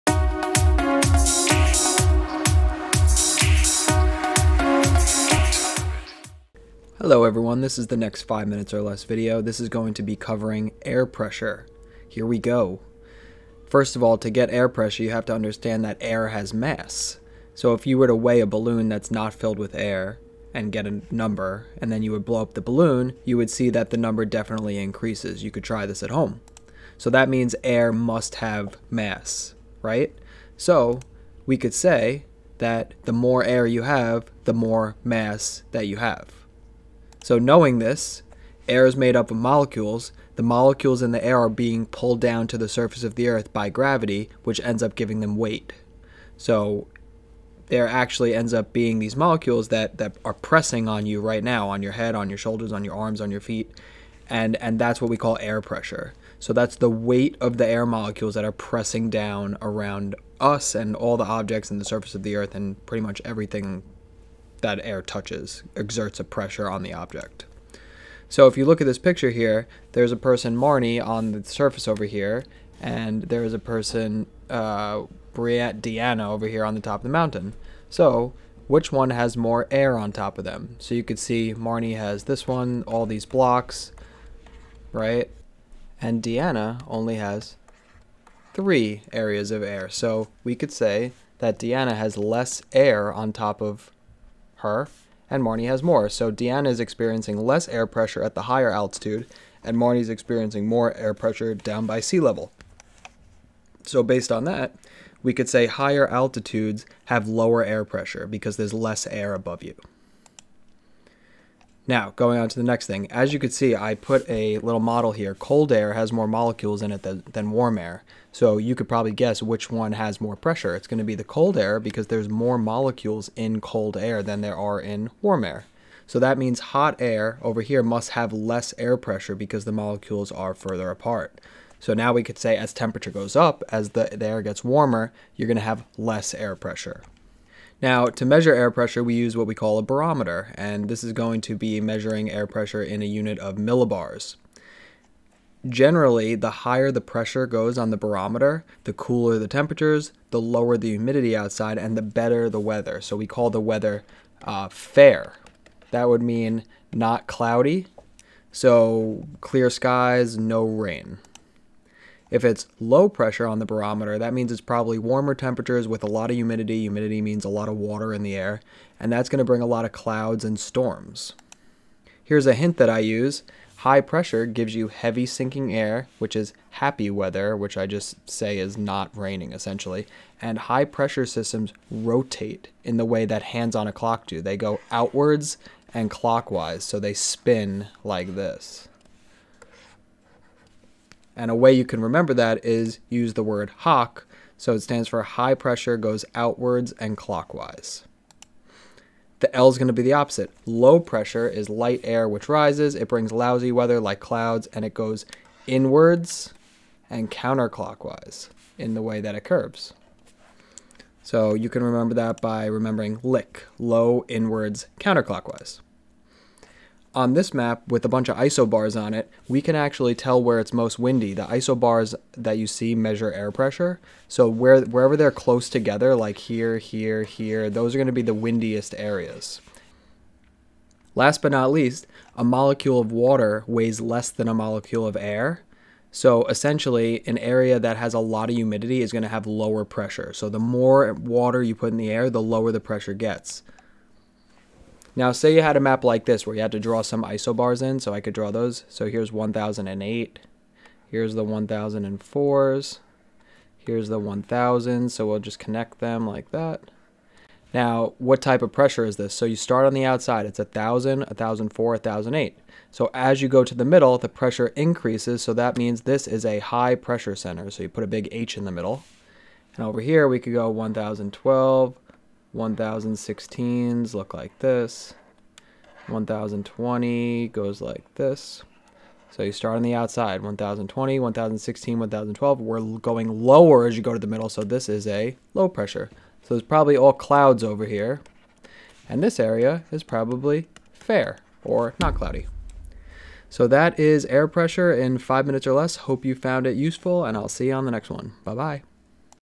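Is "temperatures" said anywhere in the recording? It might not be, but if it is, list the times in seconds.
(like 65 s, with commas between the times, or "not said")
132 s, 149 s, 165 s.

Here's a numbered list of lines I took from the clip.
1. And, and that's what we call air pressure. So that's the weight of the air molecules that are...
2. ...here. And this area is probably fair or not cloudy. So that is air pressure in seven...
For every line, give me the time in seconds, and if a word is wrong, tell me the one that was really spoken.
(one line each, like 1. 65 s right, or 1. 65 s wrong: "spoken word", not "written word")
1. 54 s right
2. 287 s wrong: "five", not "seven".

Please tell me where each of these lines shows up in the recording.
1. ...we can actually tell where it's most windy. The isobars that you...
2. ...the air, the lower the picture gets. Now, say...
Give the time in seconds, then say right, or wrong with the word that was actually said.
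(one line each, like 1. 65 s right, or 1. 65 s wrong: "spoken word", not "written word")
1. 219 s right
2. 241 s wrong: "pressure", not "picture".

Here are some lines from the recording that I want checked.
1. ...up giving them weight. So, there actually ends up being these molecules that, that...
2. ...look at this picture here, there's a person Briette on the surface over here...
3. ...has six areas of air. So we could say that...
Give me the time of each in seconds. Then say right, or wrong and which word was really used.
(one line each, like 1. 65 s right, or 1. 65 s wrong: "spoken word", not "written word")
1. 44 s right
2. 68 s wrong: "Marnie", not "Briette"
3. 87 s wrong: "three", not "six".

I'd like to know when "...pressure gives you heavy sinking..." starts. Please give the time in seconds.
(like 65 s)
173 s.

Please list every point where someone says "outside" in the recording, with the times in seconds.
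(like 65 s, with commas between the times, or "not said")
151 s, 260 s, 279 s.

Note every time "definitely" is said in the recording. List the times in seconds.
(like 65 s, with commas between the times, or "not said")
24 s.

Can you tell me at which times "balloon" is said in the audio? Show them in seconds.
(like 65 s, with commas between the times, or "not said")
18 s, 22 s.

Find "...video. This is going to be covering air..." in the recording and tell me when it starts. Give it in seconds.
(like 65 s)
9 s.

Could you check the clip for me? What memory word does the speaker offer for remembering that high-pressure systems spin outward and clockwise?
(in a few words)
hock.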